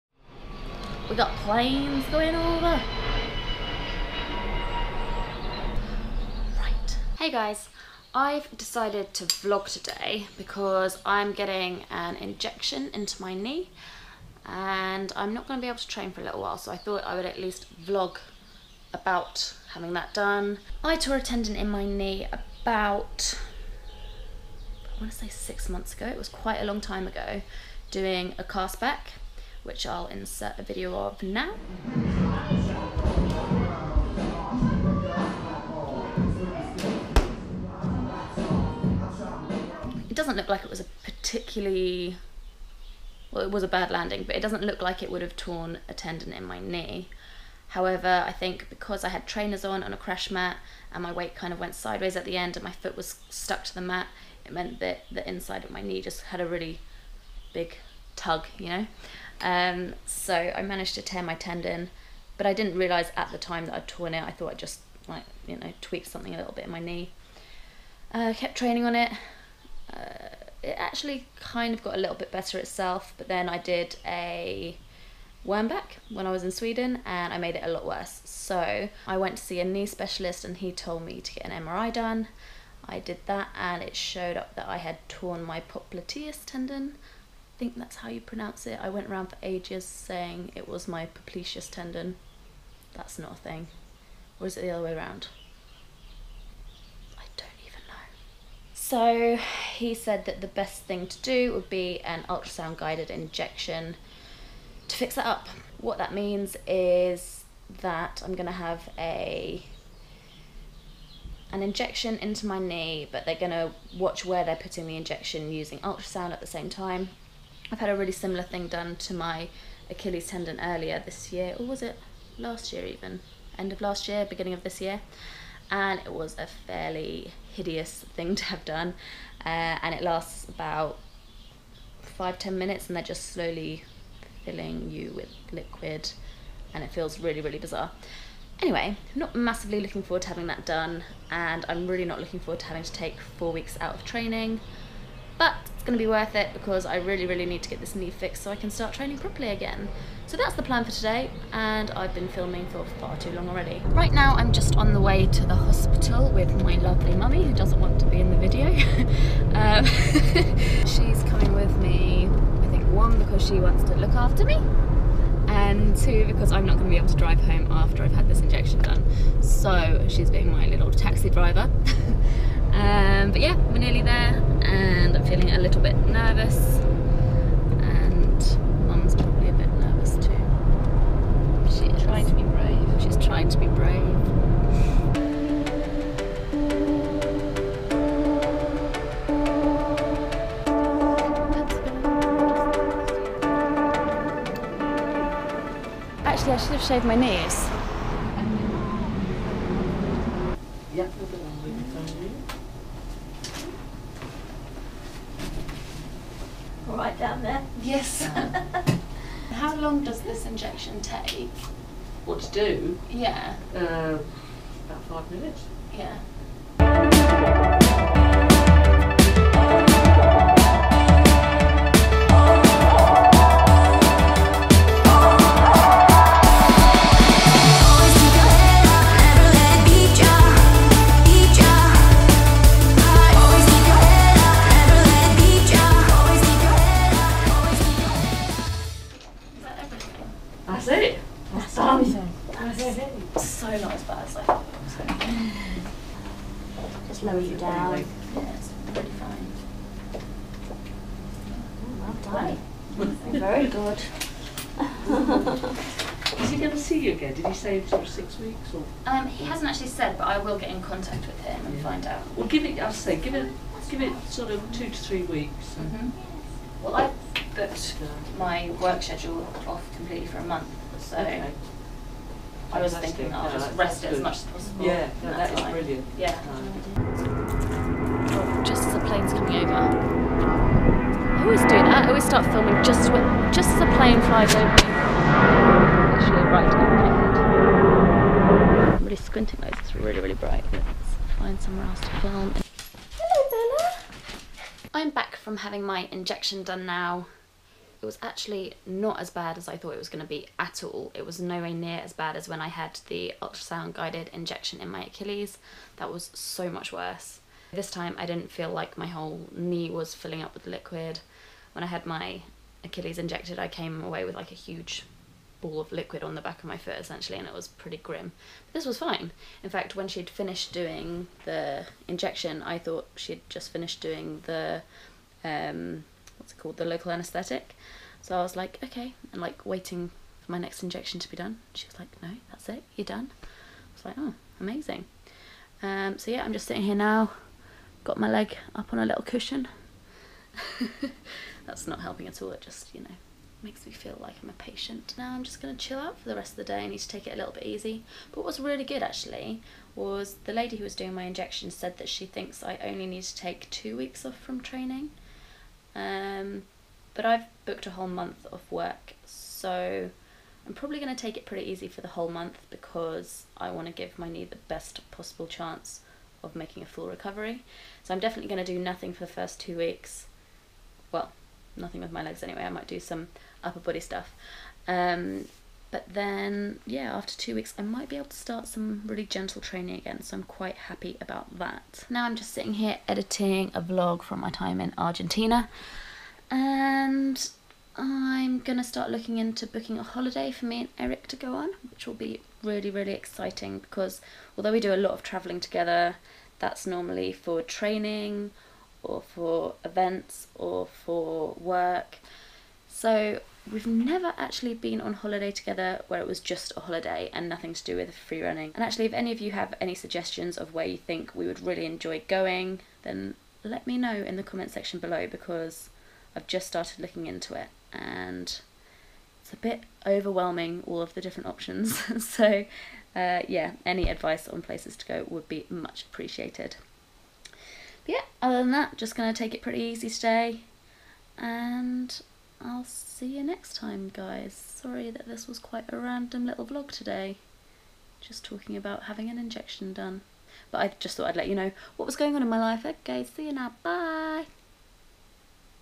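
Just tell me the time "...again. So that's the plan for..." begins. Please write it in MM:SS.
02:29.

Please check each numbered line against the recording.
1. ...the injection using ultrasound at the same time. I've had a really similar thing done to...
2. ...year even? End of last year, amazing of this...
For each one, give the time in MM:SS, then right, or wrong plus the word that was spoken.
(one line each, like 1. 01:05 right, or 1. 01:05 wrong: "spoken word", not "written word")
1. 01:54 right
2. 02:02 wrong: "beginning", not "amazing".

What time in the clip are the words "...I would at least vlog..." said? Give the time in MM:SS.
00:17.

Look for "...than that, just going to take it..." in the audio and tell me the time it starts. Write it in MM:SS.
07:08.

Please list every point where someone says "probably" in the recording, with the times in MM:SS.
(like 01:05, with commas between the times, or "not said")
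02:59, 06:00.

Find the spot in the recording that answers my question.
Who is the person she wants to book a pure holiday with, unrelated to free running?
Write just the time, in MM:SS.
06:30.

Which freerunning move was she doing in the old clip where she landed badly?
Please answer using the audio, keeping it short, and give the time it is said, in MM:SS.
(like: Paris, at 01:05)
cast back, at 00:28.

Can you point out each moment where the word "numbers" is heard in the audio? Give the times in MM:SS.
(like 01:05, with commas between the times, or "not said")
04:07.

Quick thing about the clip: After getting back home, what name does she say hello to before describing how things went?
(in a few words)
Bella.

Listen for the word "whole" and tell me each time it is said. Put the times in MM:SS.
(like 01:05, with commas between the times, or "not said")
05:09, 05:57, 06:02.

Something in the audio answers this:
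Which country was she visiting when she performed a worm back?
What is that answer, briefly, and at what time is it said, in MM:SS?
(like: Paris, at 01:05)
Sweden, at 01:16.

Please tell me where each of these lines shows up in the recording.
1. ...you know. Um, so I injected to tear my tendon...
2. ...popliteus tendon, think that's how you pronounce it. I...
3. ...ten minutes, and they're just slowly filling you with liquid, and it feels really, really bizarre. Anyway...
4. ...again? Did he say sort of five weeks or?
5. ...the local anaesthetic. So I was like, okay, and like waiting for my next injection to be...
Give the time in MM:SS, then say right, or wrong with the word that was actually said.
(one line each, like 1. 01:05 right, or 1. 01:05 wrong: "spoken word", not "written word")
1. 00:58 wrong: "managed", not "injected"
2. 01:25 right
3. 02:12 right
4. 04:17 wrong: "six", not "five"
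5. 05:26 right.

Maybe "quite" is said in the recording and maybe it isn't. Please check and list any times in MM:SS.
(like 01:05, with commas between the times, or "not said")
00:26, 06:20, 07:15.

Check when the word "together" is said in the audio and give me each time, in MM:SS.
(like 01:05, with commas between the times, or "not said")
06:35, 06:45.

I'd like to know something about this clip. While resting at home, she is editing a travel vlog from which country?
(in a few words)
Argentina.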